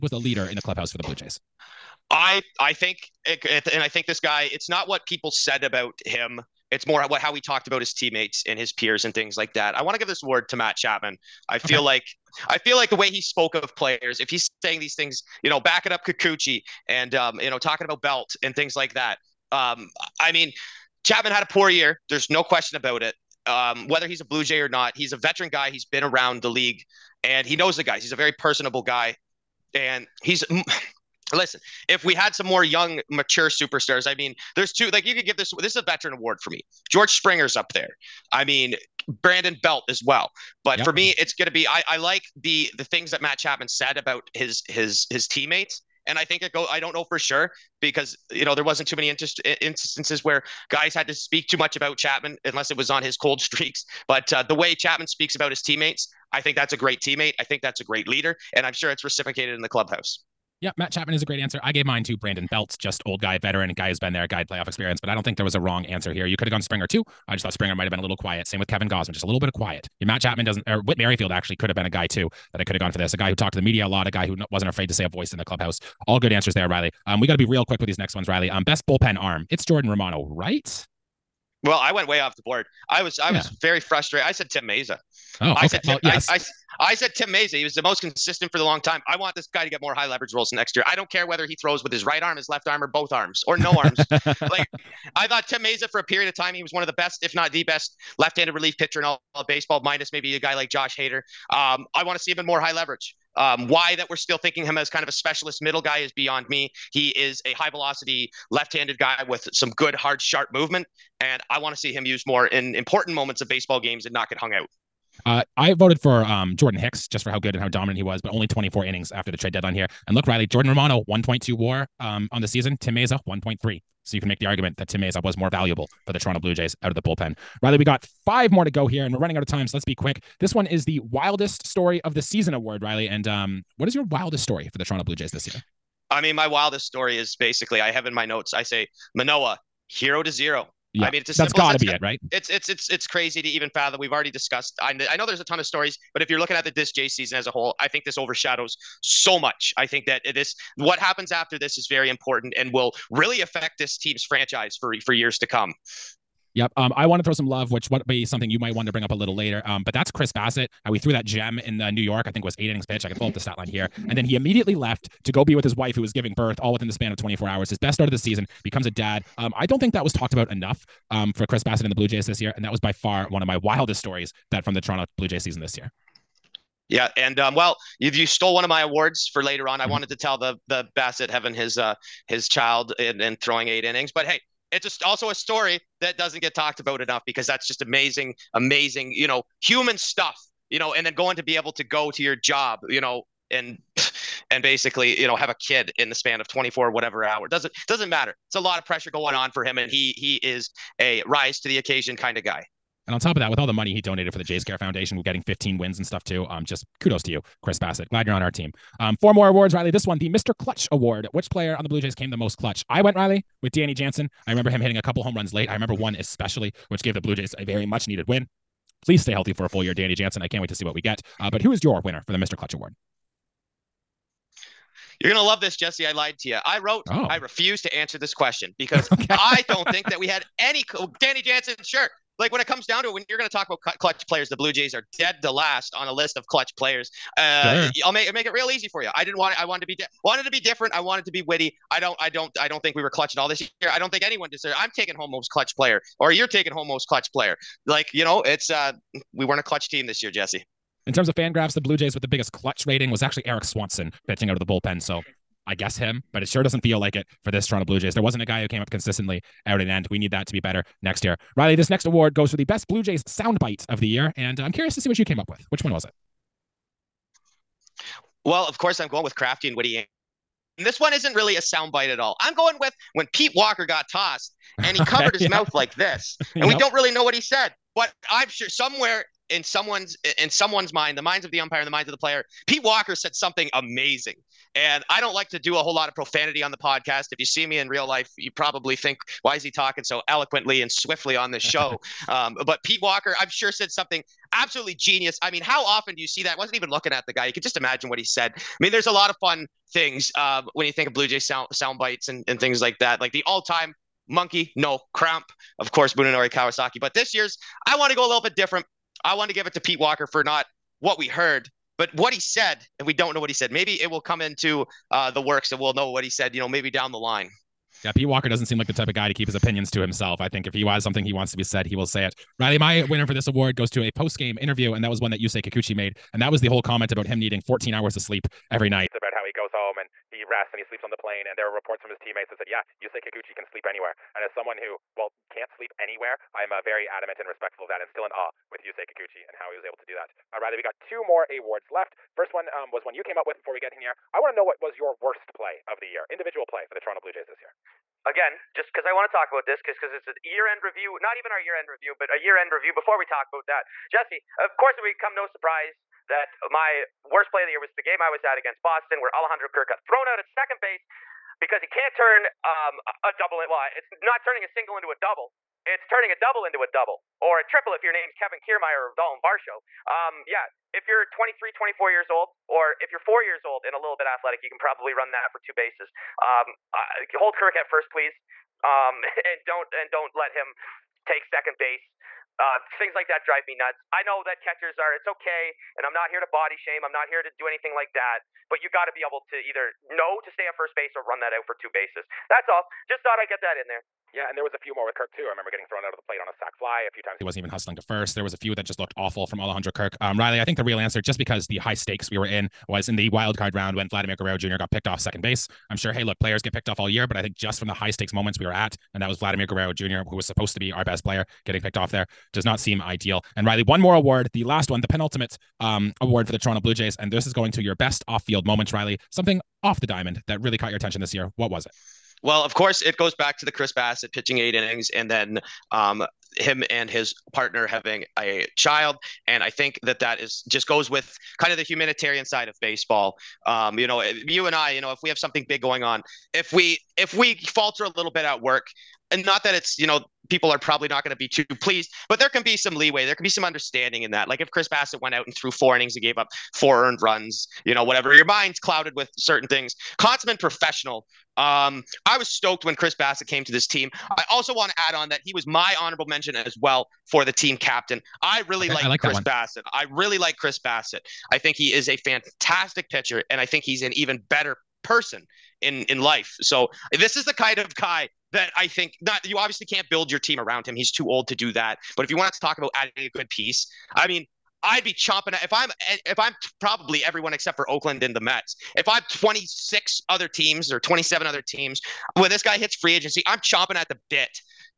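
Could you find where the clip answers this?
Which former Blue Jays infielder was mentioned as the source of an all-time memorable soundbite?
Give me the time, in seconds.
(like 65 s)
306 s.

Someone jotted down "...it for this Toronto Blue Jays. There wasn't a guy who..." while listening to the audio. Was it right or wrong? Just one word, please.
right.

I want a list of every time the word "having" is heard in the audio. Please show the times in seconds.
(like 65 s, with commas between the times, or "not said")
181 s, 427 s.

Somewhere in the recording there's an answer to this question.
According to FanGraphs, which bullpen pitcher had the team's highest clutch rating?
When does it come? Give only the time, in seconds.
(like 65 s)
253 s.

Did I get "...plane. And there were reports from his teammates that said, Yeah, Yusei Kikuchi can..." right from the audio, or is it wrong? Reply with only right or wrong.
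right.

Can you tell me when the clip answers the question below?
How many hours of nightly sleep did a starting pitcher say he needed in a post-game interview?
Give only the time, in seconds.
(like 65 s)
327 s.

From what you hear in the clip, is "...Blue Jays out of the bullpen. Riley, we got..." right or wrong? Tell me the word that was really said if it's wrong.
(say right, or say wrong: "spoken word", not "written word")
right.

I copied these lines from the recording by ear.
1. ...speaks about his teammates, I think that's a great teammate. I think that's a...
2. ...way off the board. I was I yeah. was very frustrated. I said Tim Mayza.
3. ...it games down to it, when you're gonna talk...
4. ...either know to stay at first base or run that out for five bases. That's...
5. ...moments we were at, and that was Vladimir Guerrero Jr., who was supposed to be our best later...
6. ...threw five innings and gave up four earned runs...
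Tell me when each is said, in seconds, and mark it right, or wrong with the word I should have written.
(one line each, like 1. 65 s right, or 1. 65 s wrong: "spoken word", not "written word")
1. 55 s right
2. 82 s right
3. 232 s wrong: "comes", not "games"
4. 389 s wrong: "two", not "five"
5. 408 s wrong: "player", not "later"
6. 445 s wrong: "four", not "five".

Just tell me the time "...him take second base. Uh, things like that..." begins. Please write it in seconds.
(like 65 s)
380 s.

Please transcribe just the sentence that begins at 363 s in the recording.
Well, it's not turning a single into a double.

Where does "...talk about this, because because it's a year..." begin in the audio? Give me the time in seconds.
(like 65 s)
349 s.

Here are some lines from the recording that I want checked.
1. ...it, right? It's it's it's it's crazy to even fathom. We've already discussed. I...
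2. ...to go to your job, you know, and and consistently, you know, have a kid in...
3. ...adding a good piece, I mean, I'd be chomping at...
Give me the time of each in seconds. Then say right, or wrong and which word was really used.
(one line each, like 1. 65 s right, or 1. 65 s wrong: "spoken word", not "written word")
1. 141 s right
2. 191 s wrong: "basically", not "consistently"
3. 472 s right.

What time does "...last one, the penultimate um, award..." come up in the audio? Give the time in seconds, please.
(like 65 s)
414 s.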